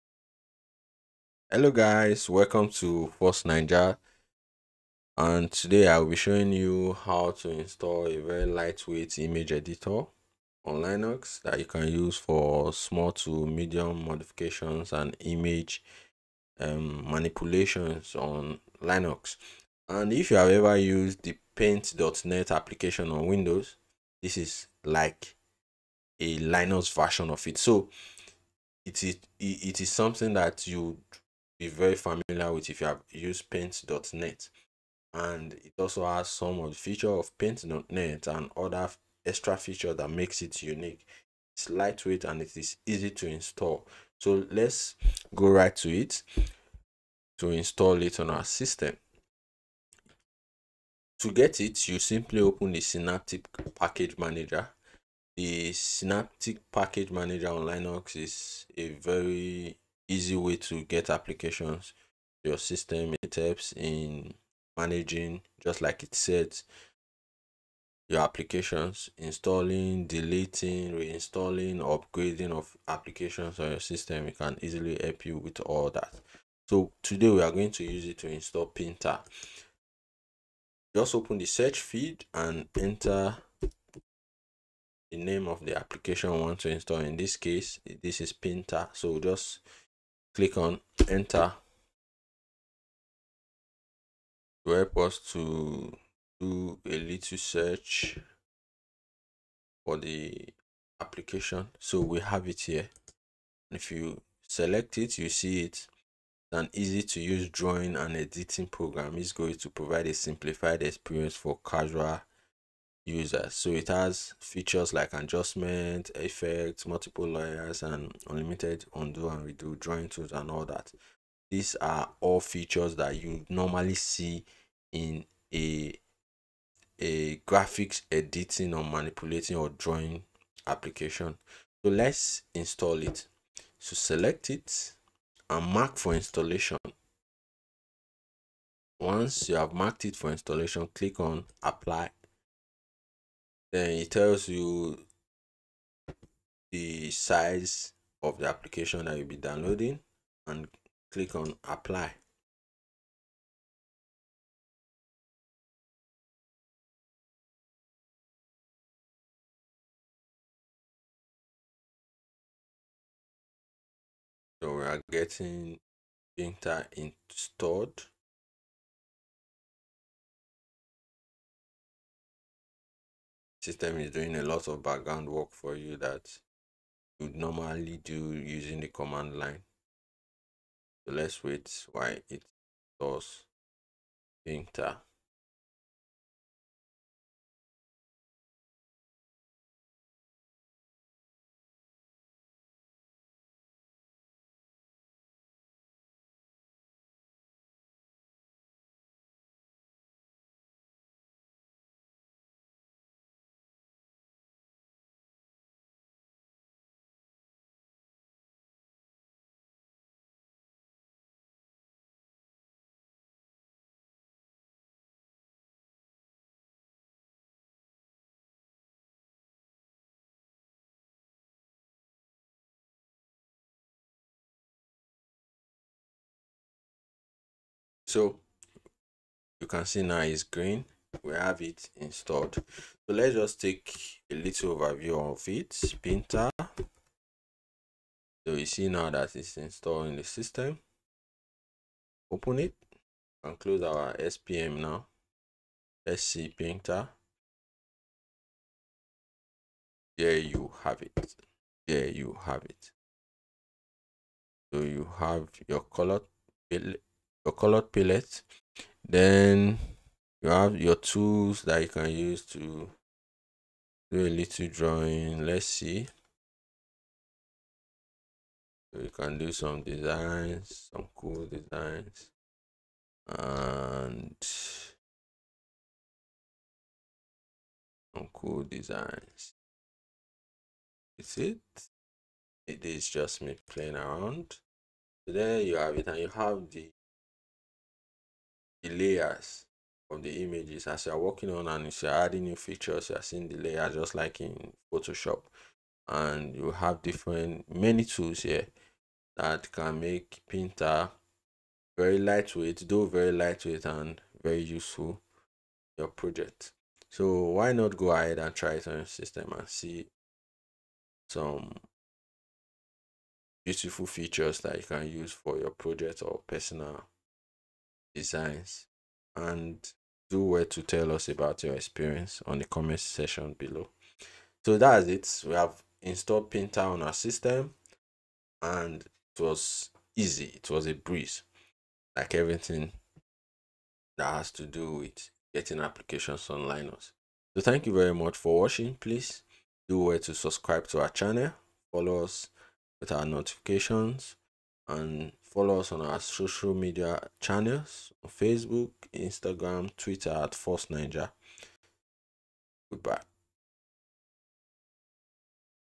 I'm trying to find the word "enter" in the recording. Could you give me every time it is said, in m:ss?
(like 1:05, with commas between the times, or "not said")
1:22, 1:31, 3:04.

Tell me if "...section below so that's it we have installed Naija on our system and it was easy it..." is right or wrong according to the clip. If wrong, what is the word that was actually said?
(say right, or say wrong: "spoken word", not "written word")
wrong: "Pinta", not "Naija".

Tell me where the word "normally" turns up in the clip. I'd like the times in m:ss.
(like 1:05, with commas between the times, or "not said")
2:03, 2:57.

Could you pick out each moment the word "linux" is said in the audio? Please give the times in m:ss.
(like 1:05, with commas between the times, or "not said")
0:10, 0:18, 0:26, 0:57, 5:36.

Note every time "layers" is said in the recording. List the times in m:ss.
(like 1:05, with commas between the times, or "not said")
1:57, 4:48, 4:53.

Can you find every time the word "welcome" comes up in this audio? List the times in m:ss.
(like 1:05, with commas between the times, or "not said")
0:02.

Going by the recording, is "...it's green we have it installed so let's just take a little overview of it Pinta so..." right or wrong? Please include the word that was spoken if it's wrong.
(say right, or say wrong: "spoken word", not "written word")
right.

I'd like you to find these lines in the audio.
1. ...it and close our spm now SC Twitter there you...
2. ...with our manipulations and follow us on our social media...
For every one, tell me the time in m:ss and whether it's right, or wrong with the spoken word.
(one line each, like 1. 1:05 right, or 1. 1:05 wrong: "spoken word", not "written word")
1. 4:02 wrong: "Pinta", not "Twitter"
2. 5:42 wrong: "notifications", not "manipulations".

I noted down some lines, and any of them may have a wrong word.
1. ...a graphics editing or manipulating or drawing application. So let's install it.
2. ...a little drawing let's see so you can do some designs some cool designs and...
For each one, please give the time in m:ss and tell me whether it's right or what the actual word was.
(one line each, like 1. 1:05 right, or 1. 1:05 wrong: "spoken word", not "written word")
1. 2:07 right
2. 4:24 right.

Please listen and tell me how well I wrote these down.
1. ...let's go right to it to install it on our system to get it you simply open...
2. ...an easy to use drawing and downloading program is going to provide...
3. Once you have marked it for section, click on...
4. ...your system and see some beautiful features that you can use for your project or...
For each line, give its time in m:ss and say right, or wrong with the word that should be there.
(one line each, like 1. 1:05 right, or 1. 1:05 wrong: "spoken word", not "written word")
1. 0:44 right
2. 1:46 wrong: "editing", not "downloading"
3. 2:18 wrong: "installation", not "section"
4. 5:08 right.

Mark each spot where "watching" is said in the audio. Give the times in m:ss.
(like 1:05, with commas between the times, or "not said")
5:38.